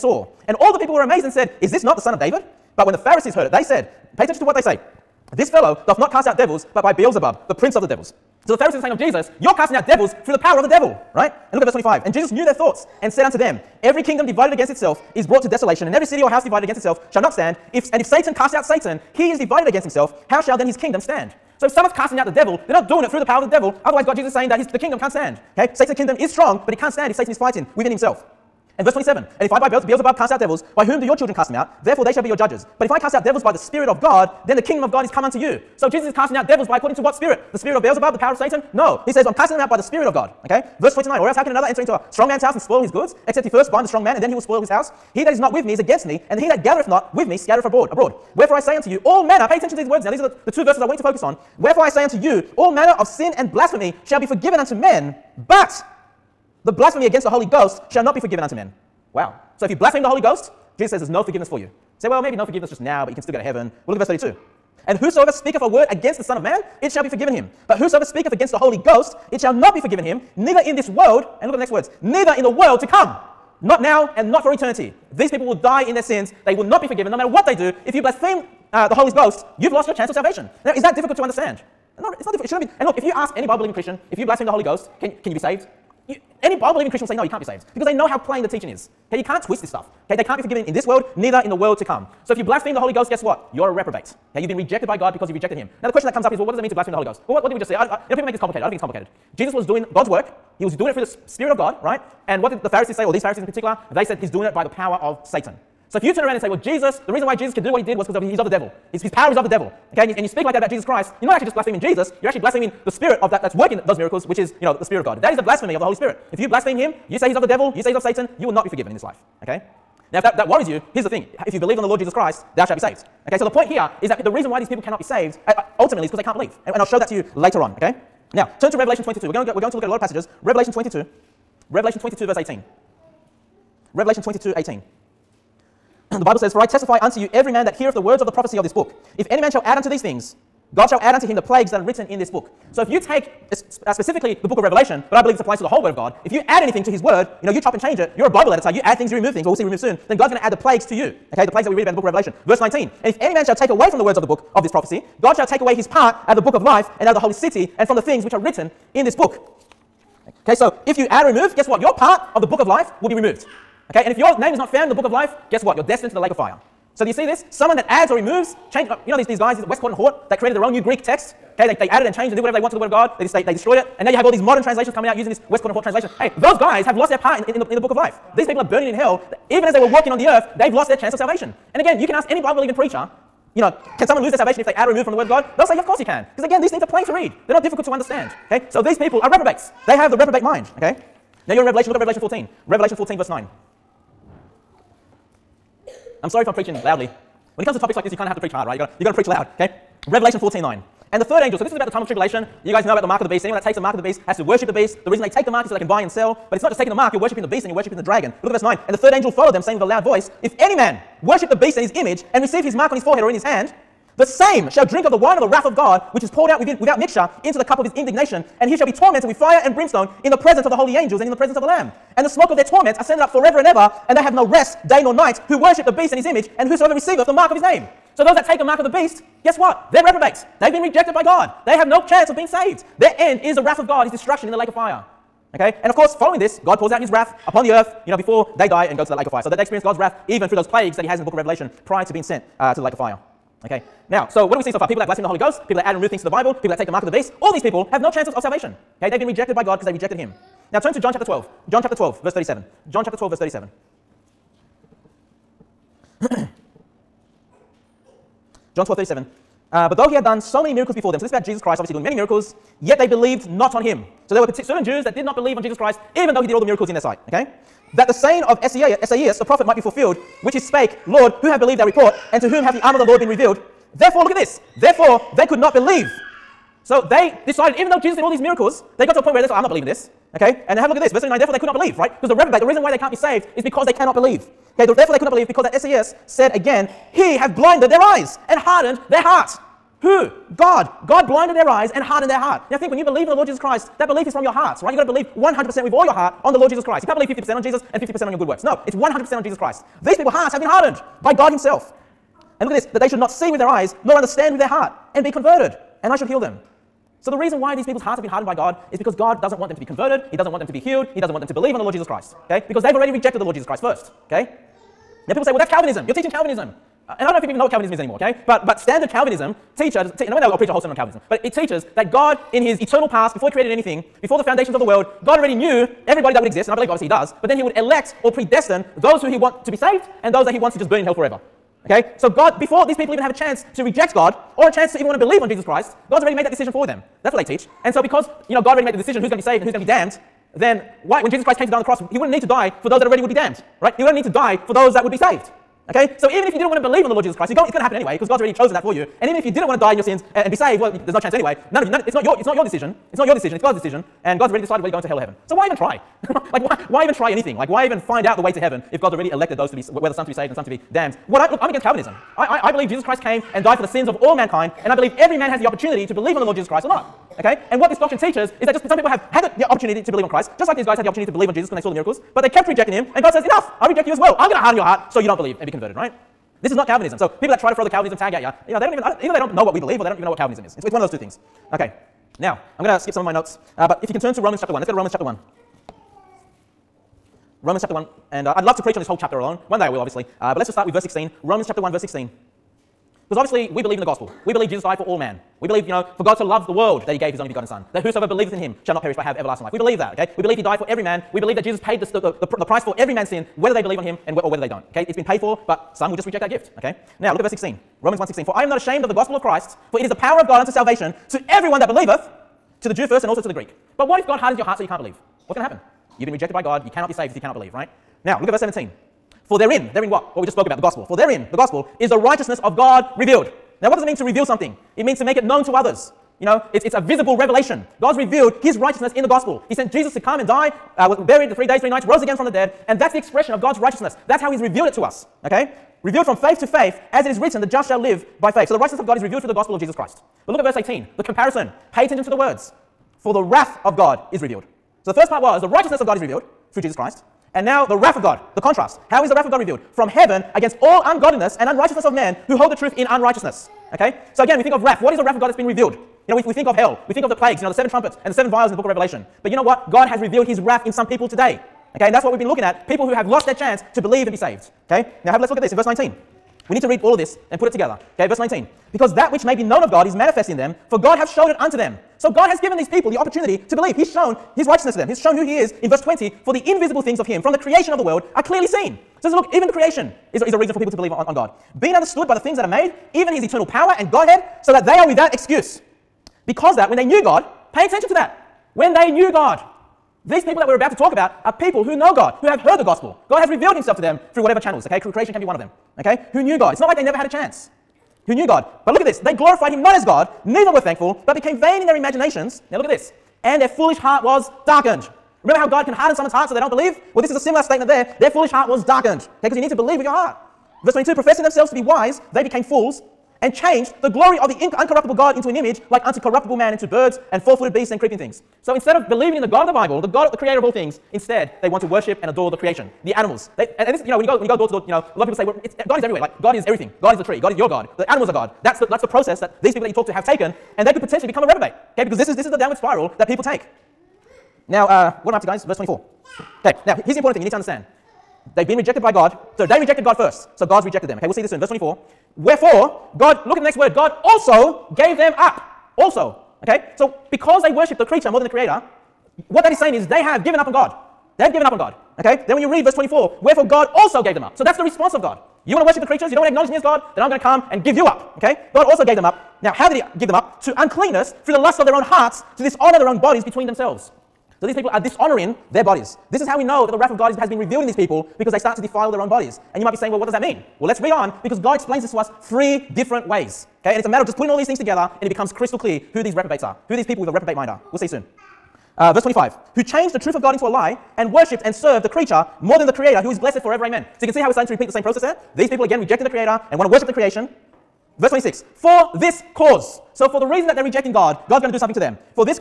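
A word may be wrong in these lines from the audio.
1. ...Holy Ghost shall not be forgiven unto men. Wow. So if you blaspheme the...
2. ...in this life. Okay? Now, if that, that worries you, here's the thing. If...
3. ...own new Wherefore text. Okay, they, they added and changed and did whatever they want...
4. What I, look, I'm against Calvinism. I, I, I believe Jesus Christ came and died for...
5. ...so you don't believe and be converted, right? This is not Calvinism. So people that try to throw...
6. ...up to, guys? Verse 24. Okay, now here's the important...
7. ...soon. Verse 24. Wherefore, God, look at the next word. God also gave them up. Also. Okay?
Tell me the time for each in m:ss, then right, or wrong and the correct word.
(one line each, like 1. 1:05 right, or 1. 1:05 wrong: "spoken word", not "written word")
1. 0:57 right
2. 1:58 right
3. 2:50 wrong: "Greek", not "Wherefore"
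4. 6:01 right
5. 6:15 right
6. 8:55 right
7. 9:01 right.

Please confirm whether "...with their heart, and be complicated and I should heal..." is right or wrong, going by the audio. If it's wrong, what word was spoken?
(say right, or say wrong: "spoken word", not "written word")
wrong: "converted", not "complicated".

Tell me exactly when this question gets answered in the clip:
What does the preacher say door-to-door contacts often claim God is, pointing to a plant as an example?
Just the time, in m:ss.
8:47.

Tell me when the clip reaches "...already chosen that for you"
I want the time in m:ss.
5:48.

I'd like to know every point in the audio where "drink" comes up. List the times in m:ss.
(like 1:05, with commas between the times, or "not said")
3:34.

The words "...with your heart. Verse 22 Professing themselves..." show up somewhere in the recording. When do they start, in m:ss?
8:29.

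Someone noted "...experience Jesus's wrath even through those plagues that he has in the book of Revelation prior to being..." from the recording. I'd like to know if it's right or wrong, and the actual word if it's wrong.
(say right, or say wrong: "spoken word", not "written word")
wrong: "God", not "Jesus".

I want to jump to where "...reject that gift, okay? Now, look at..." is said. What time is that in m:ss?
6:46.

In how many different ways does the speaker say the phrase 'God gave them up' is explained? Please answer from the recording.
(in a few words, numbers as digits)
3.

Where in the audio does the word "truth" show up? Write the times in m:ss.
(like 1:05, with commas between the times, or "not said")
7:32, 9:40.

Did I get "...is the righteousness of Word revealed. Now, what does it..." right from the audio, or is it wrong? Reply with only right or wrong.
wrong.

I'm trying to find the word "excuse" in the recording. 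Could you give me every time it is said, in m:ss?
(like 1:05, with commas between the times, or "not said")
8:05.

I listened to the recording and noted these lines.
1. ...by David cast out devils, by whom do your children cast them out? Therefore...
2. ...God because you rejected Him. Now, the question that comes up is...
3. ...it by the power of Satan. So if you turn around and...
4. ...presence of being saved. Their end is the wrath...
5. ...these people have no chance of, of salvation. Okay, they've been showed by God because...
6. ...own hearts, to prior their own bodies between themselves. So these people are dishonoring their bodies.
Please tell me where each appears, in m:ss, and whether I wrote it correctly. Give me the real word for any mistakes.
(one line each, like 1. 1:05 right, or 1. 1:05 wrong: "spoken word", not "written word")
1. 0:29 wrong: "Beelzebub", not "David"
2. 1:34 right
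3. 1:44 right
4. 3:52 wrong: "chance", not "presence"
5. 4:07 wrong: "rejected", not "showed"
6. 9:21 wrong: "dishonor", not "prior".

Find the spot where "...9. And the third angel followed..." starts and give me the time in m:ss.
3:28.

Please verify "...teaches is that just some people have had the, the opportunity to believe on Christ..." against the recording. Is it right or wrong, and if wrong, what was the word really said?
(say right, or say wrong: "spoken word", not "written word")
right.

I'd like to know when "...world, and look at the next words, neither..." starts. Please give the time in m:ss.
1:10.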